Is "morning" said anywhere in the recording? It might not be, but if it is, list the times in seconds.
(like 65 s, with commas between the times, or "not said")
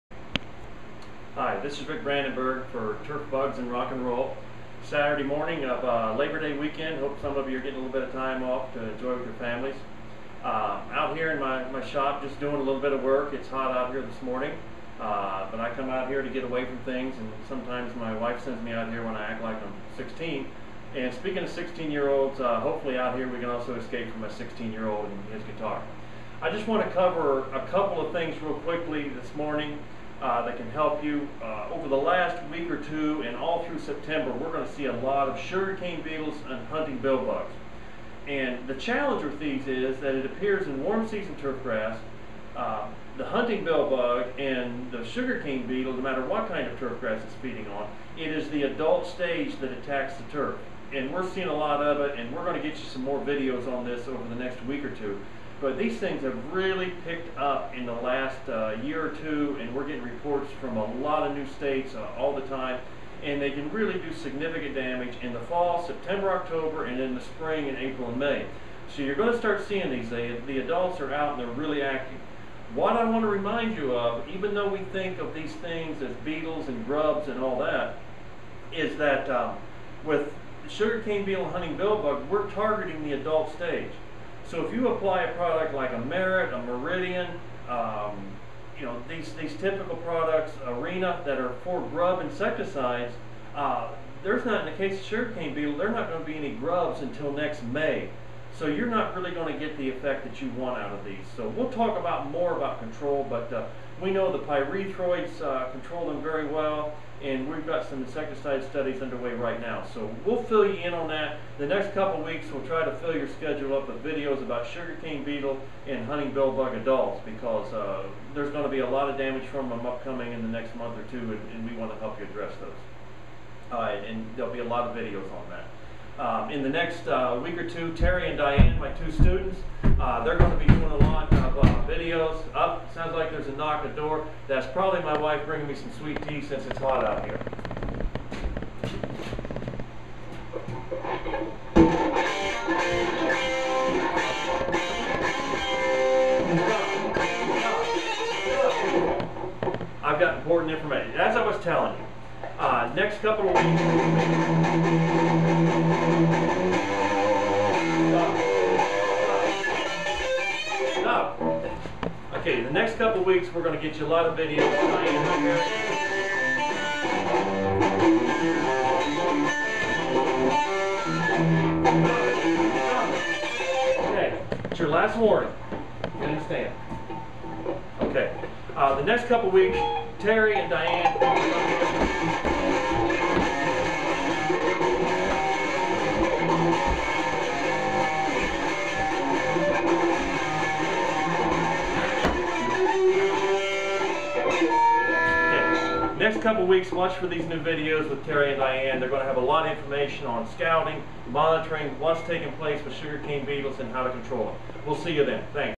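5 s, 14 s, 29 s.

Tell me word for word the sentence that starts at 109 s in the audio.
So we'll fill you in on that.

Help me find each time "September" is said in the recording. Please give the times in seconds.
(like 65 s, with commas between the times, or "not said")
33 s, 65 s.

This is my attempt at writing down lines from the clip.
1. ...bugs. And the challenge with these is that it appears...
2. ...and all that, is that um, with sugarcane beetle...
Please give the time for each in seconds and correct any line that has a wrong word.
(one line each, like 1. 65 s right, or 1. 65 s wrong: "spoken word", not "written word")
1. 37 s right
2. 77 s right.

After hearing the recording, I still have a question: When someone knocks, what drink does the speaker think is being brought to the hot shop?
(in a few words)
sweet tea.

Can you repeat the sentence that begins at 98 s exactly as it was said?
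So you're not really going to get the effect that you want out of these.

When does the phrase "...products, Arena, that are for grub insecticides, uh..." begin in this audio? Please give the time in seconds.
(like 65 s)
89 s.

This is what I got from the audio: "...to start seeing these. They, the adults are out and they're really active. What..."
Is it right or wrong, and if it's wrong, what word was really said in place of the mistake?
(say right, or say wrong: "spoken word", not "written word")
right.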